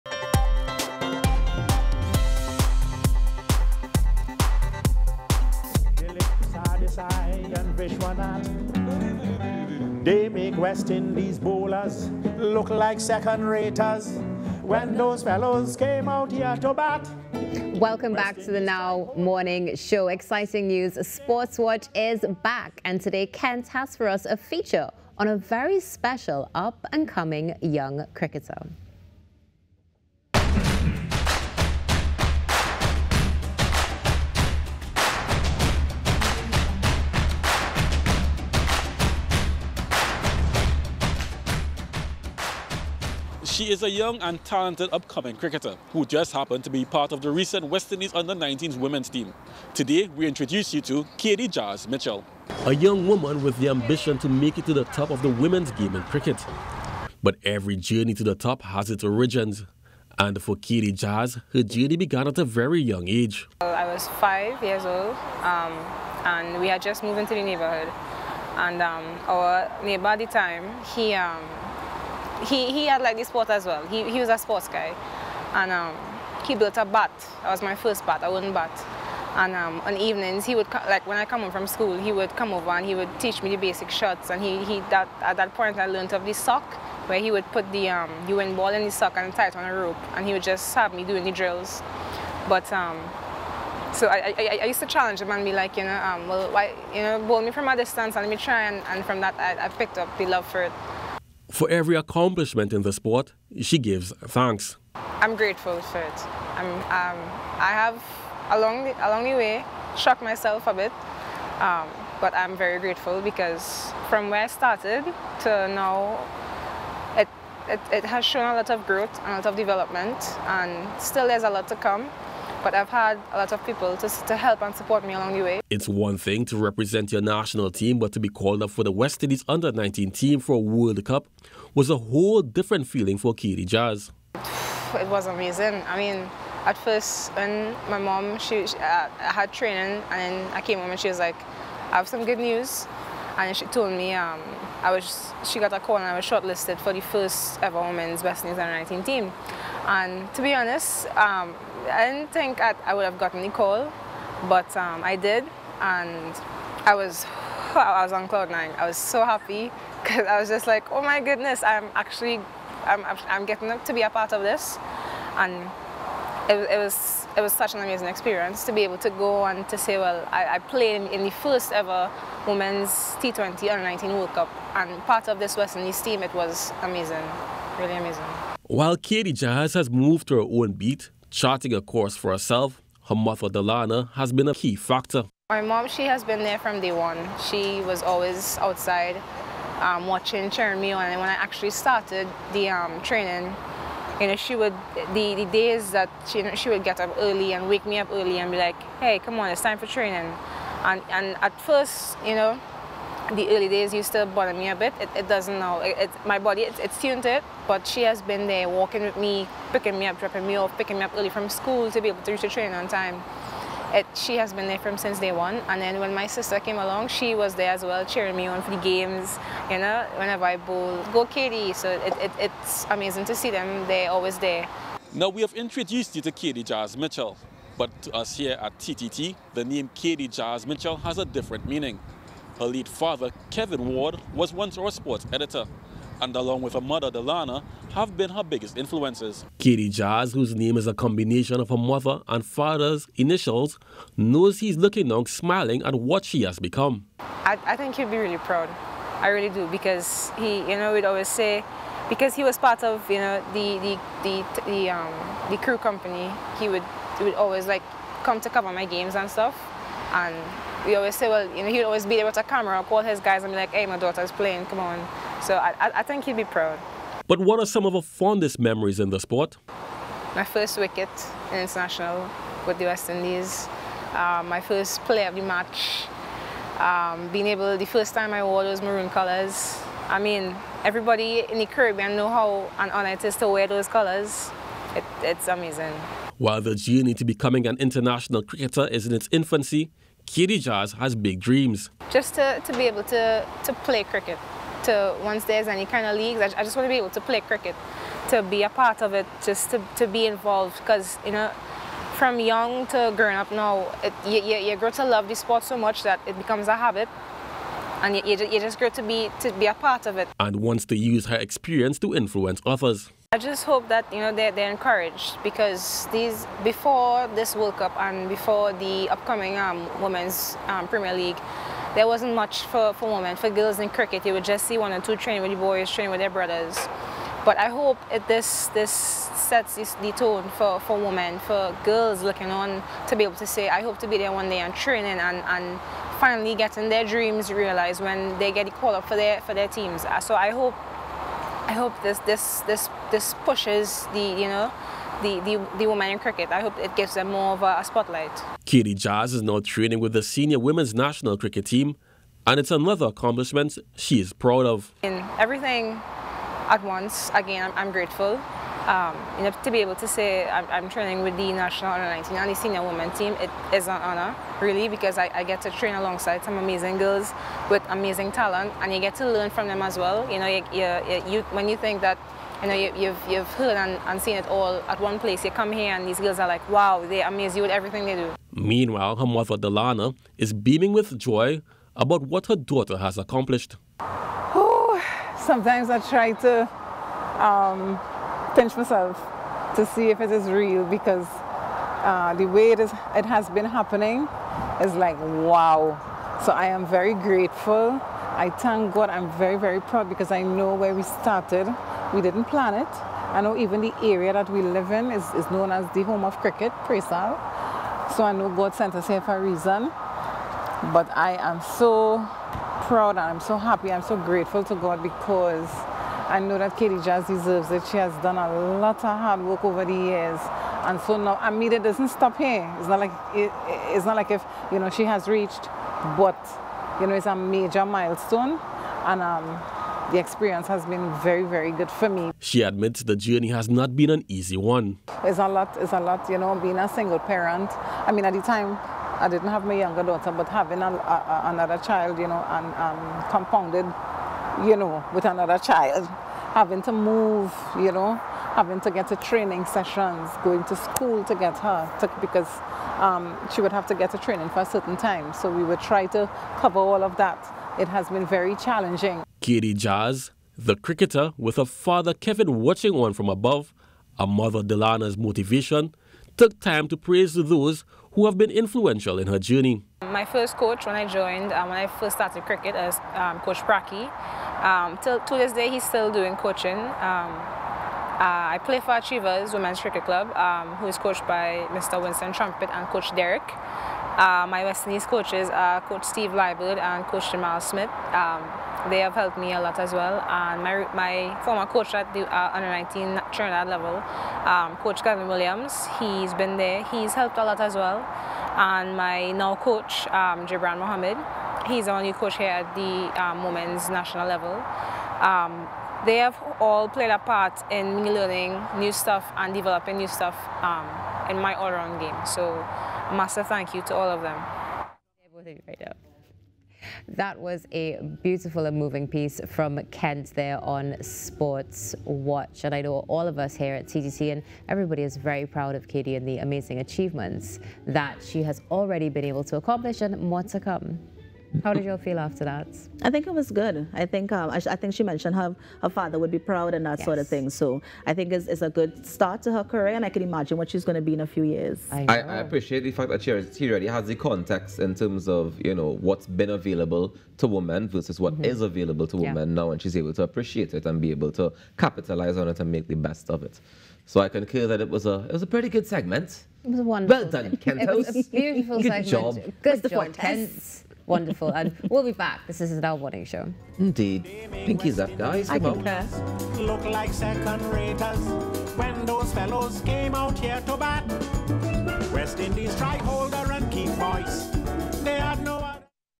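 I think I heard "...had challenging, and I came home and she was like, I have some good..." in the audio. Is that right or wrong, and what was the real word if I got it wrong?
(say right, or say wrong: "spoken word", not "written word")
wrong: "training", not "challenging".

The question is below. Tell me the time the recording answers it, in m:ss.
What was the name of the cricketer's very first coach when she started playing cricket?
7:53.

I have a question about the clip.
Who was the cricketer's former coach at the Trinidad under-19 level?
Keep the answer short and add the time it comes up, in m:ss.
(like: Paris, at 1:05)
Gavin Williams, at 8:14.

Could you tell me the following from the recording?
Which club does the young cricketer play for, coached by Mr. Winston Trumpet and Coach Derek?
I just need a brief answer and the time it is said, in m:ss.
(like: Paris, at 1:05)
Achievers Women's Cricket Club, at 7:58.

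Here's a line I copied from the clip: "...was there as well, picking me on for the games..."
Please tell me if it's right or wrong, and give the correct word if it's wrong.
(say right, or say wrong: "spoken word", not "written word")
wrong: "cheering", not "picking".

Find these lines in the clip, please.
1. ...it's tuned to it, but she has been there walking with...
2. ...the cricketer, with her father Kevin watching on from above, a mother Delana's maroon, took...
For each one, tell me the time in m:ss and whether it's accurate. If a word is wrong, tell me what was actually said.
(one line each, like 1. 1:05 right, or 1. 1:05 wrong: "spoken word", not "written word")
1. 3:26 right
2. 7:40 wrong: "motivation", not "maroon".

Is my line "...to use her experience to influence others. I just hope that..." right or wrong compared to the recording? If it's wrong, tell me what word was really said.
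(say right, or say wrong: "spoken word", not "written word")
right.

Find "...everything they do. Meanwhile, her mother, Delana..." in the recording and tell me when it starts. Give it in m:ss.
6:17.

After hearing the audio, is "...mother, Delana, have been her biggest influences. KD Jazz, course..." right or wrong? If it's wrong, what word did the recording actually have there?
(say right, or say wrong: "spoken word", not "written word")
wrong: "whose", not "course".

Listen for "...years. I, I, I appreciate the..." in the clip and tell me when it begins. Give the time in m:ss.
9:01.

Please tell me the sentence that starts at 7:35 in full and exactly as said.
So we would try to cover all of that.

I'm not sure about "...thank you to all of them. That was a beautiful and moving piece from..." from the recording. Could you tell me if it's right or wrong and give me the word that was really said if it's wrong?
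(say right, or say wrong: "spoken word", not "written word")
right.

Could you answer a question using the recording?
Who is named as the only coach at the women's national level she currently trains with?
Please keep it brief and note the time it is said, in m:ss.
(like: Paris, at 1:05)
Gibran Mohammed, at 8:20.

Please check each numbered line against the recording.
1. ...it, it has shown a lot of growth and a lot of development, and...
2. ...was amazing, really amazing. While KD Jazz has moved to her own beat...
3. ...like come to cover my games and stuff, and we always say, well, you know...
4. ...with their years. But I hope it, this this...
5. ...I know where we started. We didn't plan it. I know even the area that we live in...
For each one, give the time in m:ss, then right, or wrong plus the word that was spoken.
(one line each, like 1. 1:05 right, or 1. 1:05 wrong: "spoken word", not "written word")
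1. 1:57 right
2. 2:56 right
3. 4:17 right
4. 5:26 wrong: "brothers", not "years"
5. 6:40 right.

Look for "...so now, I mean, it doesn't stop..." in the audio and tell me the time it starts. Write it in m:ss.
7:01.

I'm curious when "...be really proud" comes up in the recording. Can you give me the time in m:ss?
4:08.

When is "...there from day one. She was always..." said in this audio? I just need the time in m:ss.
3:06.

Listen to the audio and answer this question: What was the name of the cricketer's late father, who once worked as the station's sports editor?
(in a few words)
Kevin Ward.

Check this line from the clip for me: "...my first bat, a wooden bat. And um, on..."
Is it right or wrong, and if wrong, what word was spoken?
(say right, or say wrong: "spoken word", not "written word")
right.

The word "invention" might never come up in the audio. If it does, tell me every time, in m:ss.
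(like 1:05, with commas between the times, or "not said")
not said.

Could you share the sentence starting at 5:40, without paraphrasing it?
So I hope I hope this this this this pushes the you know the, the, the women in cricket.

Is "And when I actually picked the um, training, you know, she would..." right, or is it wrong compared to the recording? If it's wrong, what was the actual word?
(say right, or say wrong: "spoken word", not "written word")
wrong: "started", not "picked".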